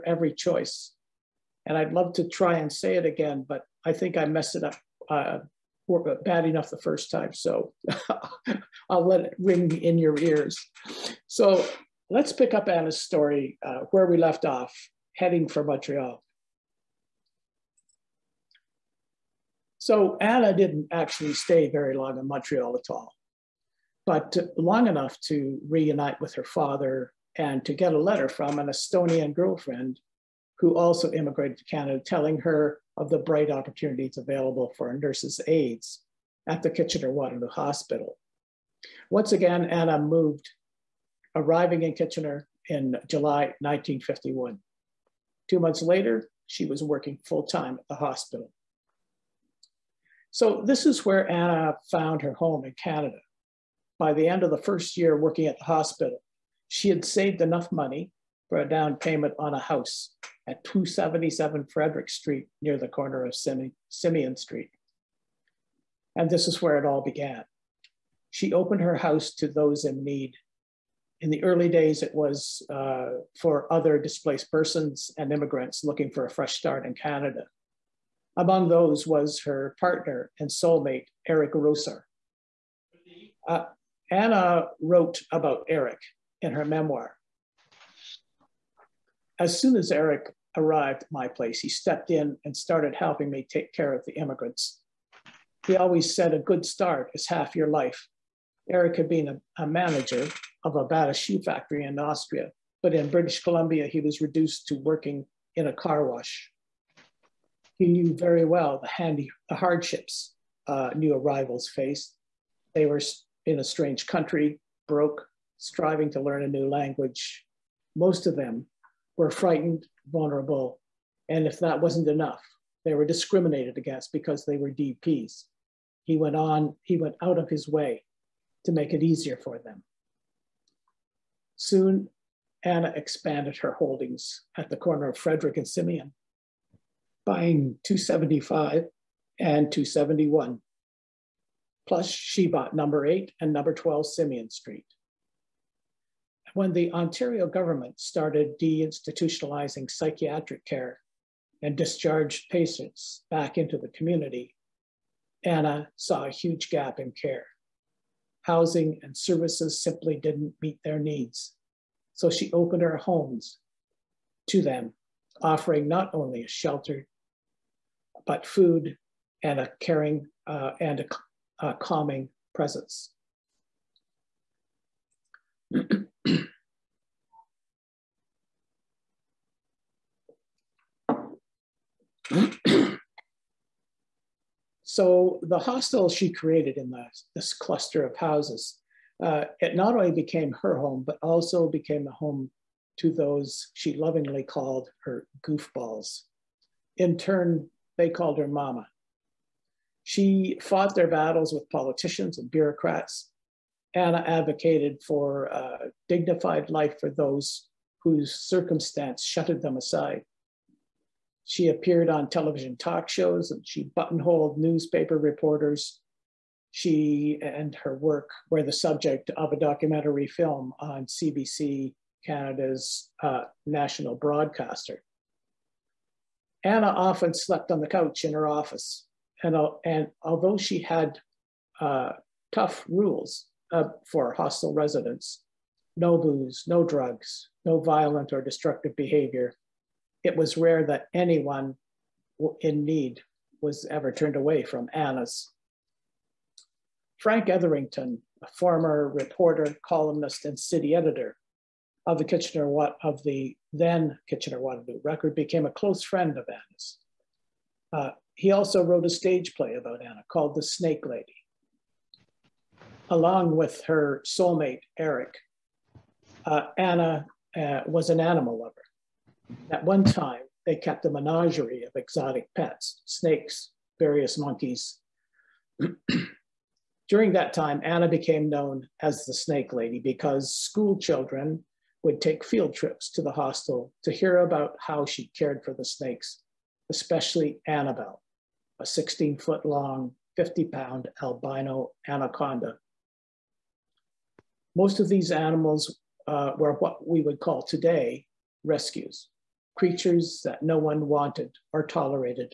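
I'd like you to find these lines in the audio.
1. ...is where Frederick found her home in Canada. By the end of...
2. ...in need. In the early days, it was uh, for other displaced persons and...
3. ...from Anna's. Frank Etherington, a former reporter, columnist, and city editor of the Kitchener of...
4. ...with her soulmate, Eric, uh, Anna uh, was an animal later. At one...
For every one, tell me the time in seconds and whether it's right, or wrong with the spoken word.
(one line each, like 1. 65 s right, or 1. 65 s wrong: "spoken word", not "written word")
1. 50 s wrong: "Anna", not "Frederick"
2. 69 s right
3. 244 s right
4. 263 s wrong: "lover", not "later".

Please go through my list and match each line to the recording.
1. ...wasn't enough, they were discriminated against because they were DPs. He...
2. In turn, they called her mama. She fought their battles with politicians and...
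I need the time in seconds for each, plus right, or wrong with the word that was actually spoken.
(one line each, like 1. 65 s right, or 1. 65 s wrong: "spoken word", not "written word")
1. 121 s right
2. 196 s right.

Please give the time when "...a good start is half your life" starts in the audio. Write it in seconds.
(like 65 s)
96 s.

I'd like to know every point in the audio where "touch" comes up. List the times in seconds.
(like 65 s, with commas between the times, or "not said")
not said.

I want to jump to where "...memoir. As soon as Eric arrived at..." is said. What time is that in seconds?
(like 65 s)
86 s.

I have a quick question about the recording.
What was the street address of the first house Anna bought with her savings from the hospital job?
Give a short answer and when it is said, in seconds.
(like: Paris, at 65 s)
277 Frederick Street, at 60 s.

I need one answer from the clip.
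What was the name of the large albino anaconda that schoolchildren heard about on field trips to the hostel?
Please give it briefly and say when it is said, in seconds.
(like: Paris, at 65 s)
Annabelle, at 287 s.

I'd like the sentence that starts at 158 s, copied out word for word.
Housing and services simply didn't meet their needs.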